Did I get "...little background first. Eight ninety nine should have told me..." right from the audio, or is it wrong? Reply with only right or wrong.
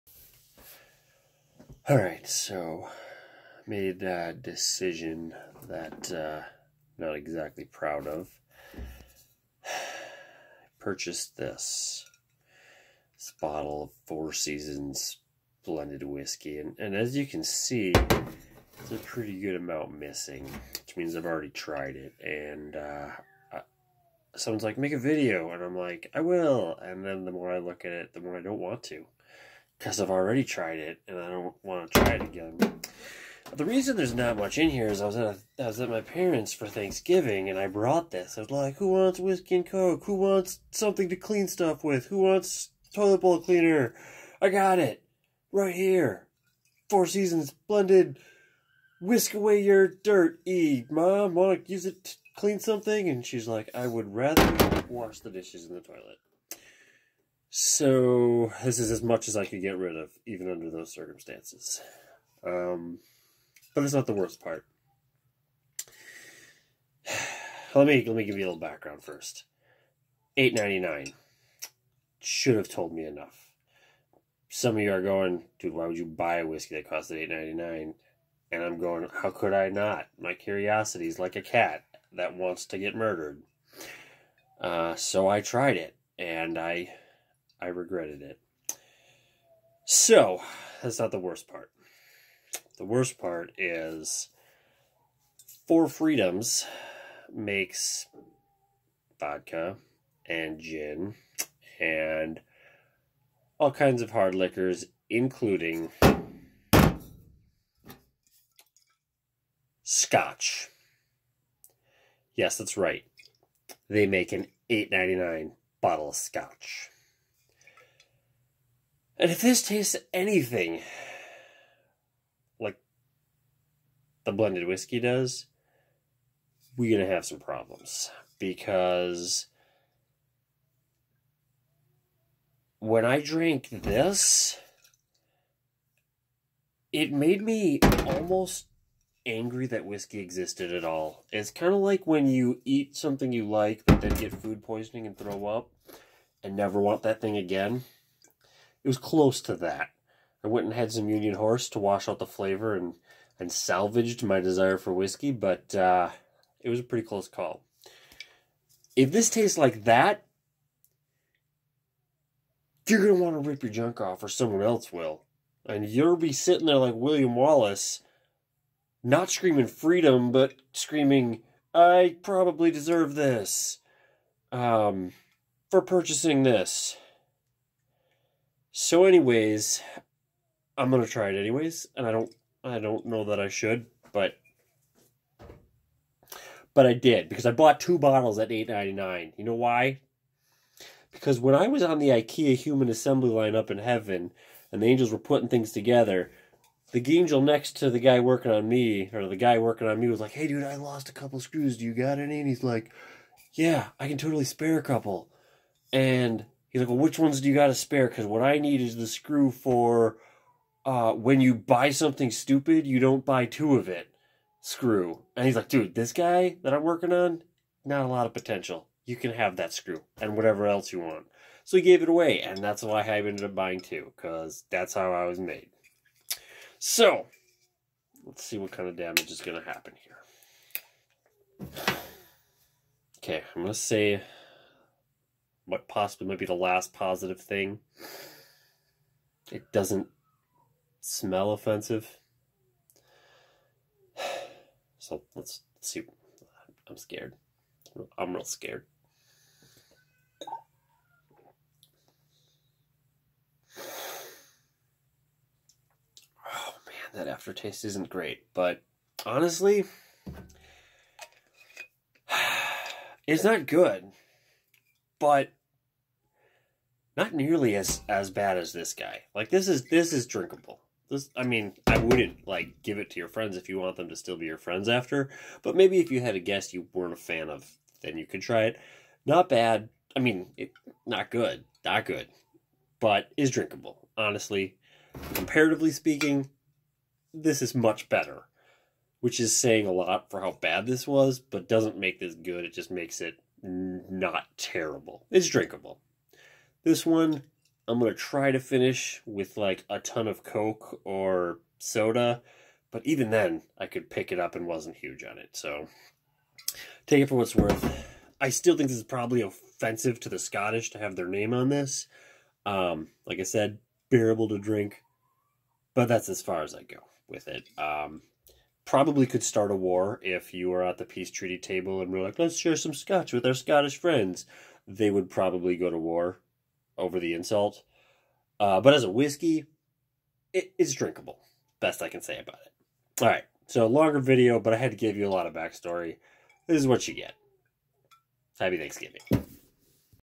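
right.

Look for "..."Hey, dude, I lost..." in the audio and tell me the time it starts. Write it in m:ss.
3:20.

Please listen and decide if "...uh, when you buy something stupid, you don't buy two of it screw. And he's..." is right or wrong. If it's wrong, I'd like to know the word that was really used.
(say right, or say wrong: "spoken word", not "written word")
right.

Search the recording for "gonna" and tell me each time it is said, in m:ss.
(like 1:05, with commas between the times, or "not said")
2:43, 3:00.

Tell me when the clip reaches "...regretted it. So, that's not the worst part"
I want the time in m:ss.
1:27.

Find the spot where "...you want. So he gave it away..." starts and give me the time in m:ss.
3:40.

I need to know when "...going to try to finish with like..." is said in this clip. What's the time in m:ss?
4:57.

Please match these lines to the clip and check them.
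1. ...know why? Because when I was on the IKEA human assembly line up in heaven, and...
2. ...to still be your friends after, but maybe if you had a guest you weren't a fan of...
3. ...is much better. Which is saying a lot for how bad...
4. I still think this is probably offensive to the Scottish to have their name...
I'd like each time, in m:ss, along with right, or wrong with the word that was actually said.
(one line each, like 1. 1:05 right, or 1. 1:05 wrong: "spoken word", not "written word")
1. 3:09 right
2. 4:34 right
3. 4:47 right
4. 5:08 right.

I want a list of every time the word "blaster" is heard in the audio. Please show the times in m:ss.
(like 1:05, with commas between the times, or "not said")
not said.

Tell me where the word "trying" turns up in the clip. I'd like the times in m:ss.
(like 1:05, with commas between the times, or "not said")
not said.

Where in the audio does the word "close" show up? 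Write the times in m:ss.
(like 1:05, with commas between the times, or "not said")
2:28, 2:37.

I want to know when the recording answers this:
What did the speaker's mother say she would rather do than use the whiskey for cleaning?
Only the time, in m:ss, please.
0:54.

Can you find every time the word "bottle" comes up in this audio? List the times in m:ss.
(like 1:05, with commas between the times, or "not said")
0:13, 1:55, 3:07.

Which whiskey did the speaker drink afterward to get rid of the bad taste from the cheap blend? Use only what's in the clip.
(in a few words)
Union Horse.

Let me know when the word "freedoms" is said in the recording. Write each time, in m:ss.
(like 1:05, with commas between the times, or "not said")
0:14, 0:47, 1:35, 2:49.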